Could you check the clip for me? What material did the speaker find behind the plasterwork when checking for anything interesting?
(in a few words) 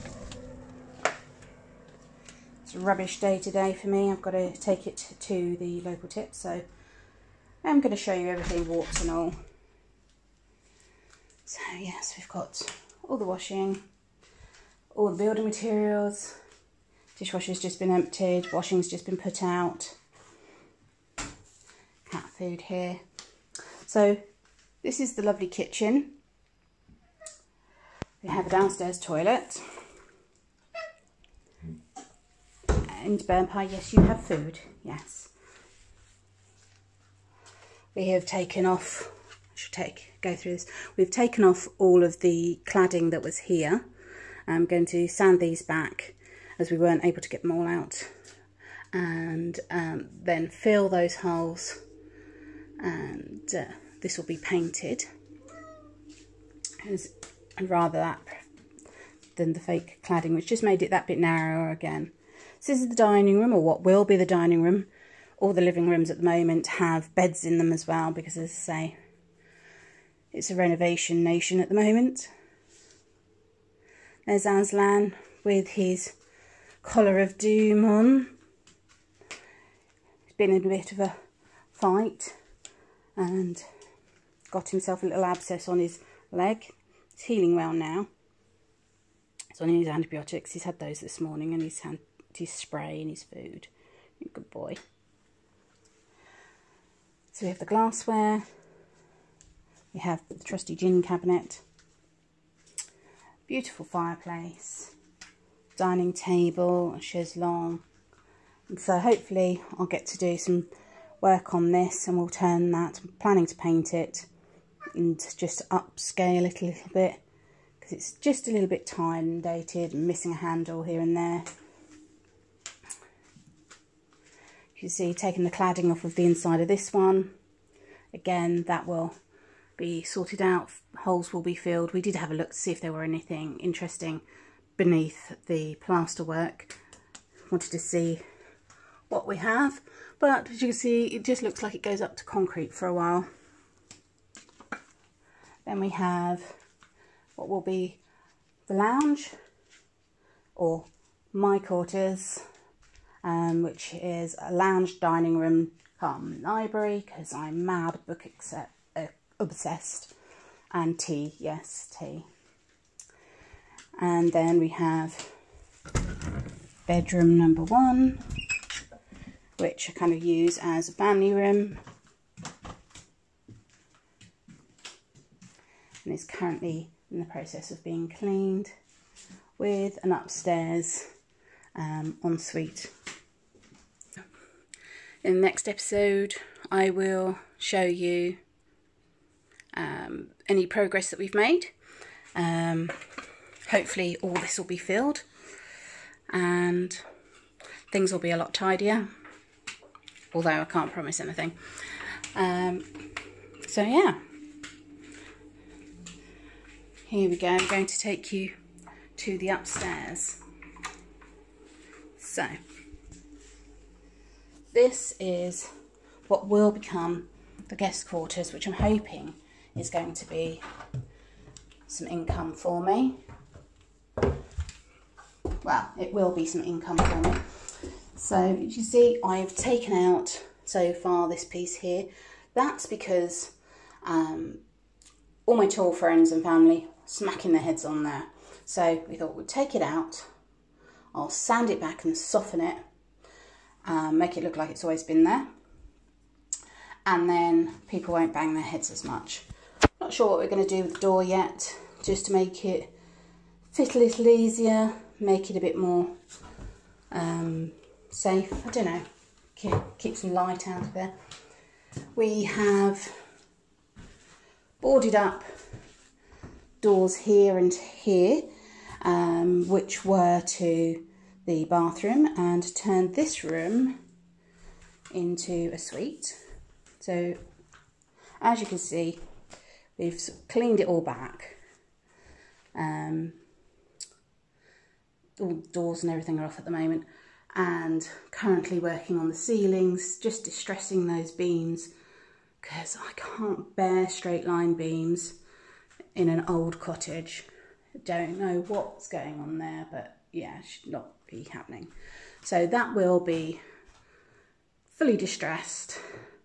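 concrete.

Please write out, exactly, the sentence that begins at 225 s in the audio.
Well, it will be some income for me.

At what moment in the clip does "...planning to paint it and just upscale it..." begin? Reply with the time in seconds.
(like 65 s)
113 s.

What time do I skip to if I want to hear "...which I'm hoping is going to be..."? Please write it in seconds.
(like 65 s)
218 s.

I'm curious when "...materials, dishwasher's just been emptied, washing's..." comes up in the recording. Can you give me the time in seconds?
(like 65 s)
15 s.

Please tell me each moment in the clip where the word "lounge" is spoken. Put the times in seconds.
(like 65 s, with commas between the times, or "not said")
148 s, 154 s.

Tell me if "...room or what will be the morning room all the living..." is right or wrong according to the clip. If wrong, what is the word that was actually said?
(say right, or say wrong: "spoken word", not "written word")
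wrong: "dining", not "morning".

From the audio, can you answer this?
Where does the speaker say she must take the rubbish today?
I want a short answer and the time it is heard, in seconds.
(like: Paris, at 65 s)
the local tip, at 5 s.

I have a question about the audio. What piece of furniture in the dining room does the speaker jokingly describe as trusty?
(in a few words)
gin cabinet.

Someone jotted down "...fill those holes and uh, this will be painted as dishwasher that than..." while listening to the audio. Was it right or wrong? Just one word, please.
wrong.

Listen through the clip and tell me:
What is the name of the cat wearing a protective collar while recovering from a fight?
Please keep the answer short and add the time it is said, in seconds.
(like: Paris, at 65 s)
Aslan, at 74 s.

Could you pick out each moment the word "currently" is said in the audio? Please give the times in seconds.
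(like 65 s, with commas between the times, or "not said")
176 s, 288 s.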